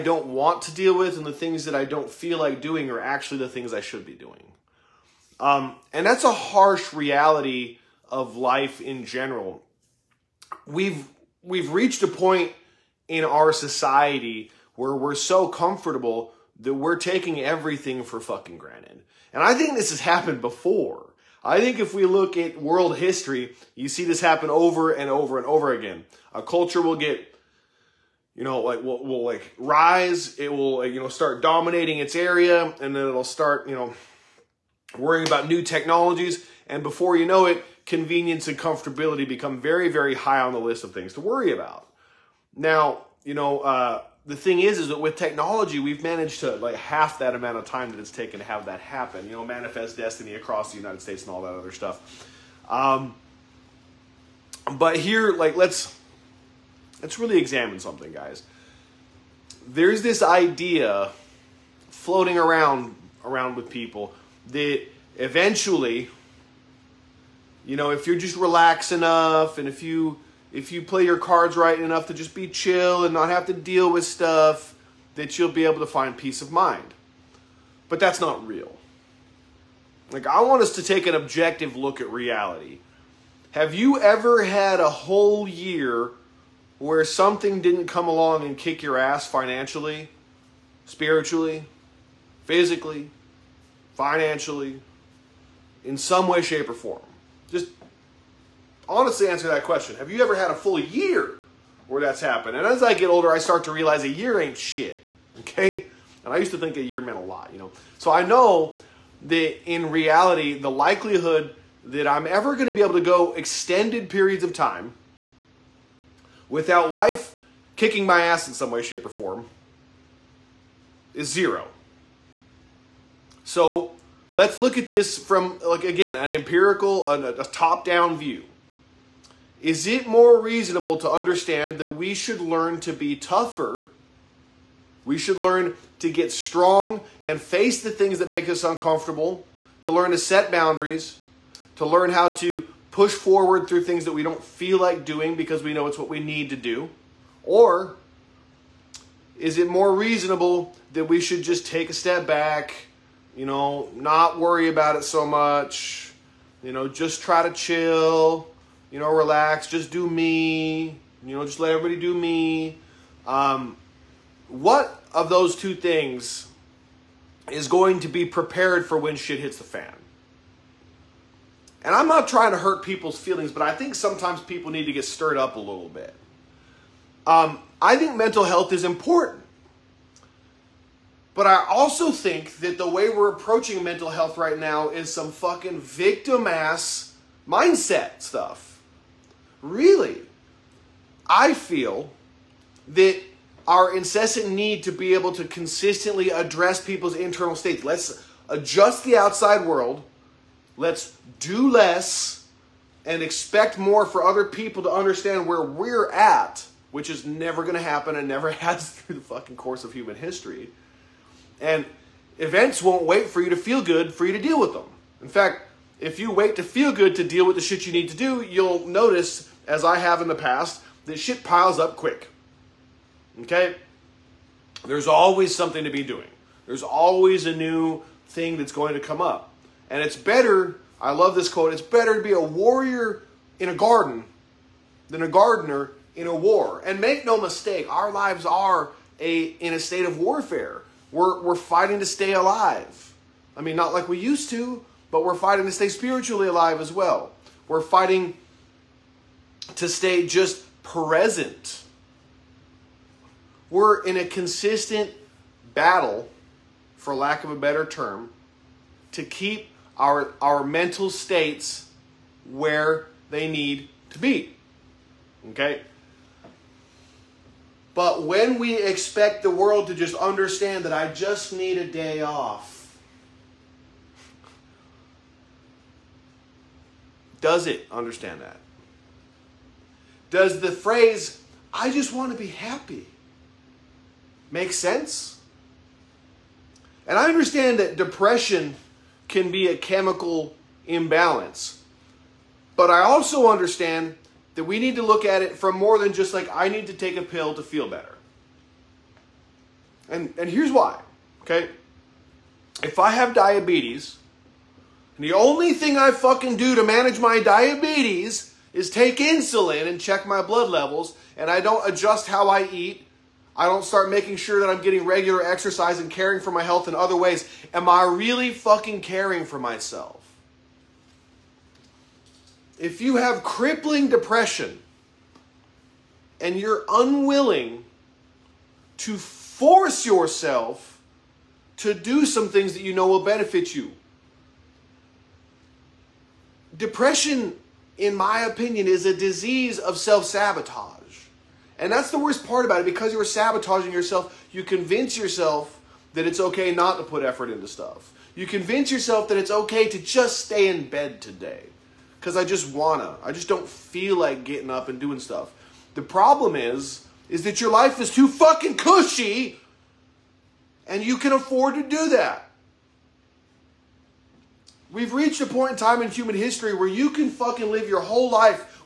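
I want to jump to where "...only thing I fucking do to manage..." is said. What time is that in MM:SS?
05:05.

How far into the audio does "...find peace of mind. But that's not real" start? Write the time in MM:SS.
01:15.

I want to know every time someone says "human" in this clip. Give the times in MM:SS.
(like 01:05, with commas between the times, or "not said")
03:29, 06:06.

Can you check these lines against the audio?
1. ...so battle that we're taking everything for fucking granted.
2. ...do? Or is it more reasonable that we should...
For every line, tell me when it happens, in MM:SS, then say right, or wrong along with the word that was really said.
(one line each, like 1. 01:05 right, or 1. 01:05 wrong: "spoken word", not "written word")
1. 00:15 wrong: "comfortable", not "battle"
2. 02:26 right.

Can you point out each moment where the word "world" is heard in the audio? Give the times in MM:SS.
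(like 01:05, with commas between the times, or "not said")
00:22, 03:19, 04:29.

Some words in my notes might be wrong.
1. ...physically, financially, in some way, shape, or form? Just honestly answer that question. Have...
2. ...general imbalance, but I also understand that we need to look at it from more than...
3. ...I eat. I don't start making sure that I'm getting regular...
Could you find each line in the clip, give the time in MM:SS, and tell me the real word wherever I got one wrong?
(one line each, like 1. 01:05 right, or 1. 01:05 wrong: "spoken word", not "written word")
1. 01:32 right
2. 04:49 wrong: "chemical", not "general"
3. 05:12 right.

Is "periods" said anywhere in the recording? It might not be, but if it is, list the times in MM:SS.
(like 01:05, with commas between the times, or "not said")
01:54.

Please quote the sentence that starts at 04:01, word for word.
We're, we're fighting to stay alive.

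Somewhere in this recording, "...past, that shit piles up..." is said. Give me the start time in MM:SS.
03:40.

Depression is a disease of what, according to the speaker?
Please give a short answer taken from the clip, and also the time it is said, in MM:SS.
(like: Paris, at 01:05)
Self sabotage, at 05:39.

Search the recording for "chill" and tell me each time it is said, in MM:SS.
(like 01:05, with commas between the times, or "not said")
01:12, 02:37.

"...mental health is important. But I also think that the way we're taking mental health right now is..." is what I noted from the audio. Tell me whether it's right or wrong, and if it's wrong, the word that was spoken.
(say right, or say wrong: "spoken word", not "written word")
wrong: "approaching", not "taking".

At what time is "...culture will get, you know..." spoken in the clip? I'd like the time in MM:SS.
00:26.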